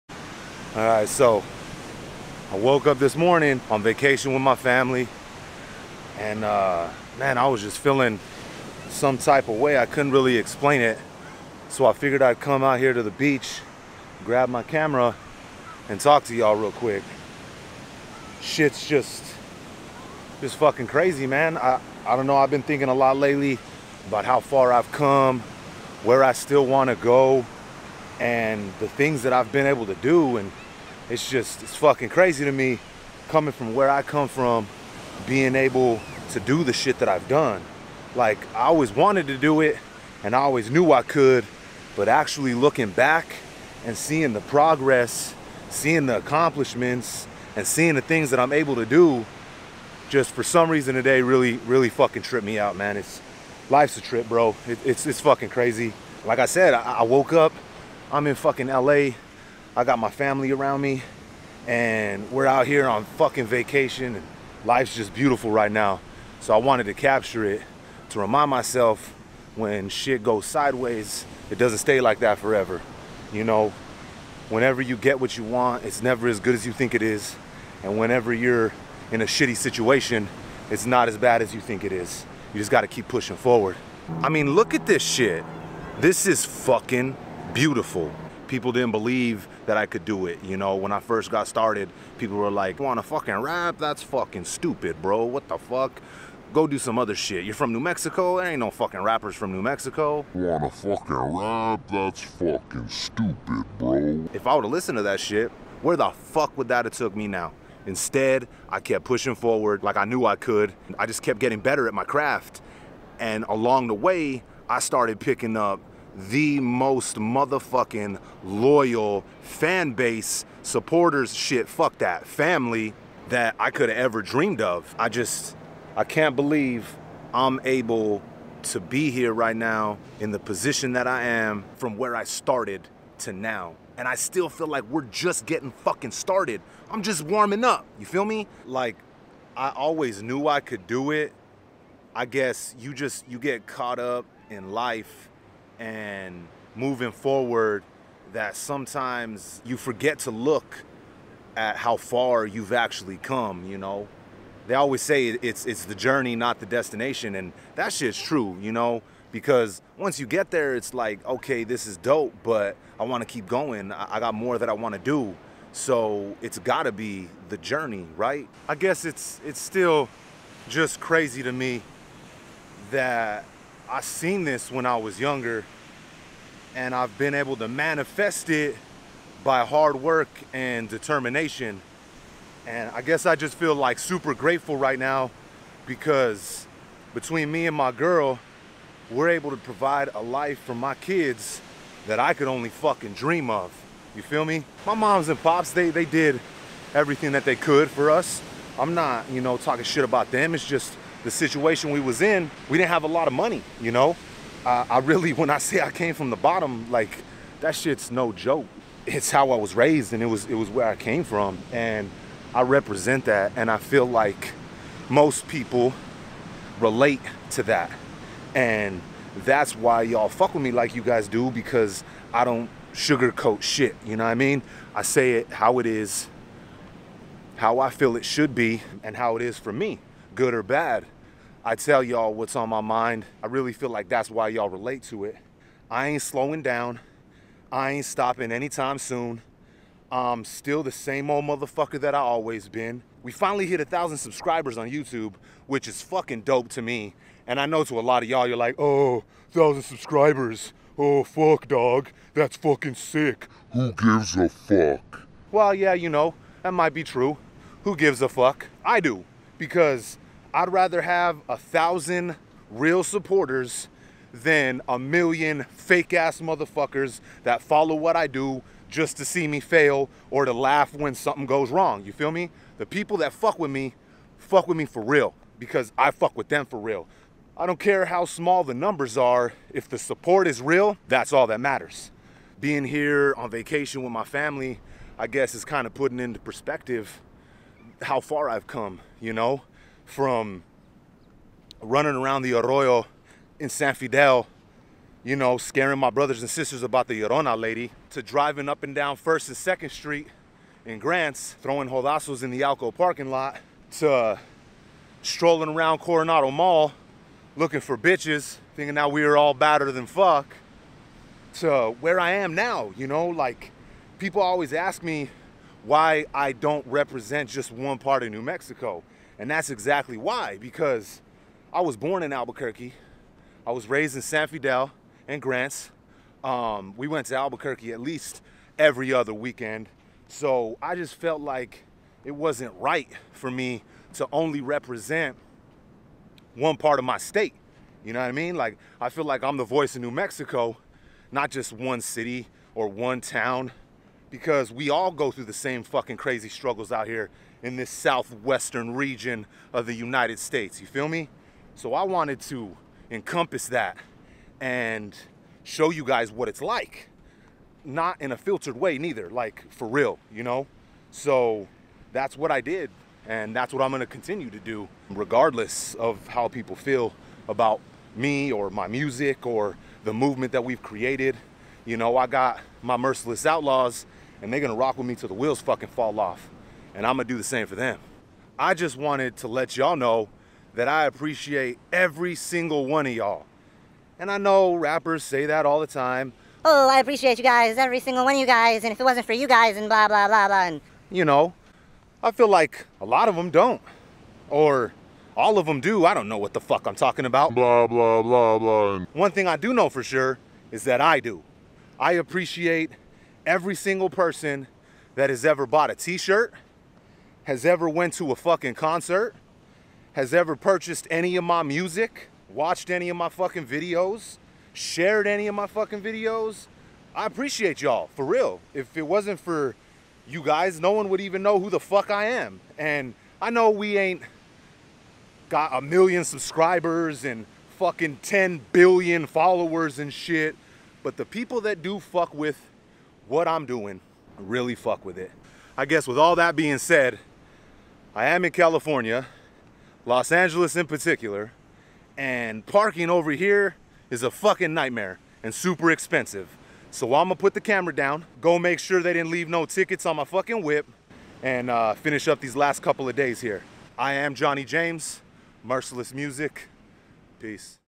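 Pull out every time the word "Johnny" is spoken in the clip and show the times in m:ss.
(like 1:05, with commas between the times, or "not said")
7:34.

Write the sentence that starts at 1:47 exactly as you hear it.
Instead, I kept pushing forward like I knew I could.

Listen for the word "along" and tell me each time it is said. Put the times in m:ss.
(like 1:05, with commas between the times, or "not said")
1:53.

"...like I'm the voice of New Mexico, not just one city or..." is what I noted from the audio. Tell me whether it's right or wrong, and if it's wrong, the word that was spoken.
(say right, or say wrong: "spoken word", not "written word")
right.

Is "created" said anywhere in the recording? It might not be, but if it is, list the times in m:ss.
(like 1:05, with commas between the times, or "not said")
6:10.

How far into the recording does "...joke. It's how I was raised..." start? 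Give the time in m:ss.
3:28.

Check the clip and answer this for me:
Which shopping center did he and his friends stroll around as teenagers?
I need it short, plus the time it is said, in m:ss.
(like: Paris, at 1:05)
Coronado Mall, at 5:05.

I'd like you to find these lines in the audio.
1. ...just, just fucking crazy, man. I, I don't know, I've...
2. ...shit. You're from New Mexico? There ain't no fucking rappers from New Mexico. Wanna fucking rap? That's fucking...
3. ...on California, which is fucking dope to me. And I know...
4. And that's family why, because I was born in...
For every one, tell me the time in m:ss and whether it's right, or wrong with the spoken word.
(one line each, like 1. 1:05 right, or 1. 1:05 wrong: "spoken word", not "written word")
1. 0:18 right
2. 1:37 right
3. 4:04 wrong: "YouTube", not "California"
4. 5:19 wrong: "exactly", not "family".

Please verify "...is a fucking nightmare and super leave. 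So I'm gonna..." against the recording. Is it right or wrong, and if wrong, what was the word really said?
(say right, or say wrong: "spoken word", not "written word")
wrong: "expensive", not "leave".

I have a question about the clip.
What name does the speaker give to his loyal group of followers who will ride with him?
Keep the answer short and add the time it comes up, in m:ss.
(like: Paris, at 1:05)
Merciless Outlaws, at 6:12.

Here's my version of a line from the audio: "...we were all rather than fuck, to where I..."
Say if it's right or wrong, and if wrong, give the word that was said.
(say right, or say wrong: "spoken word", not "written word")
wrong: "badder", not "rather".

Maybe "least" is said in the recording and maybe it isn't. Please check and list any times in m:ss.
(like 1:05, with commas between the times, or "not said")
5:27.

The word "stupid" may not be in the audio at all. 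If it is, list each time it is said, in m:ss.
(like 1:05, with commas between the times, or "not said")
1:34, 1:42.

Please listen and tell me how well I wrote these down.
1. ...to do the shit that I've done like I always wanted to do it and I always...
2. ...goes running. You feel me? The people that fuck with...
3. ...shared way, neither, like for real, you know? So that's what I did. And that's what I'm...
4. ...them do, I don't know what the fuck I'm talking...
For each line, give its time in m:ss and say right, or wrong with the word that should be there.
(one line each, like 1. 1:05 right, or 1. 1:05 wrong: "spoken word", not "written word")
1. 0:36 right
2. 4:31 wrong: "wrong", not "running"
3. 5:58 wrong: "filtered", not "shared"
4. 6:35 right.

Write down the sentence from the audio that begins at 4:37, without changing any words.
I don't care how small the numbers are, if the support is real, that's all that matters.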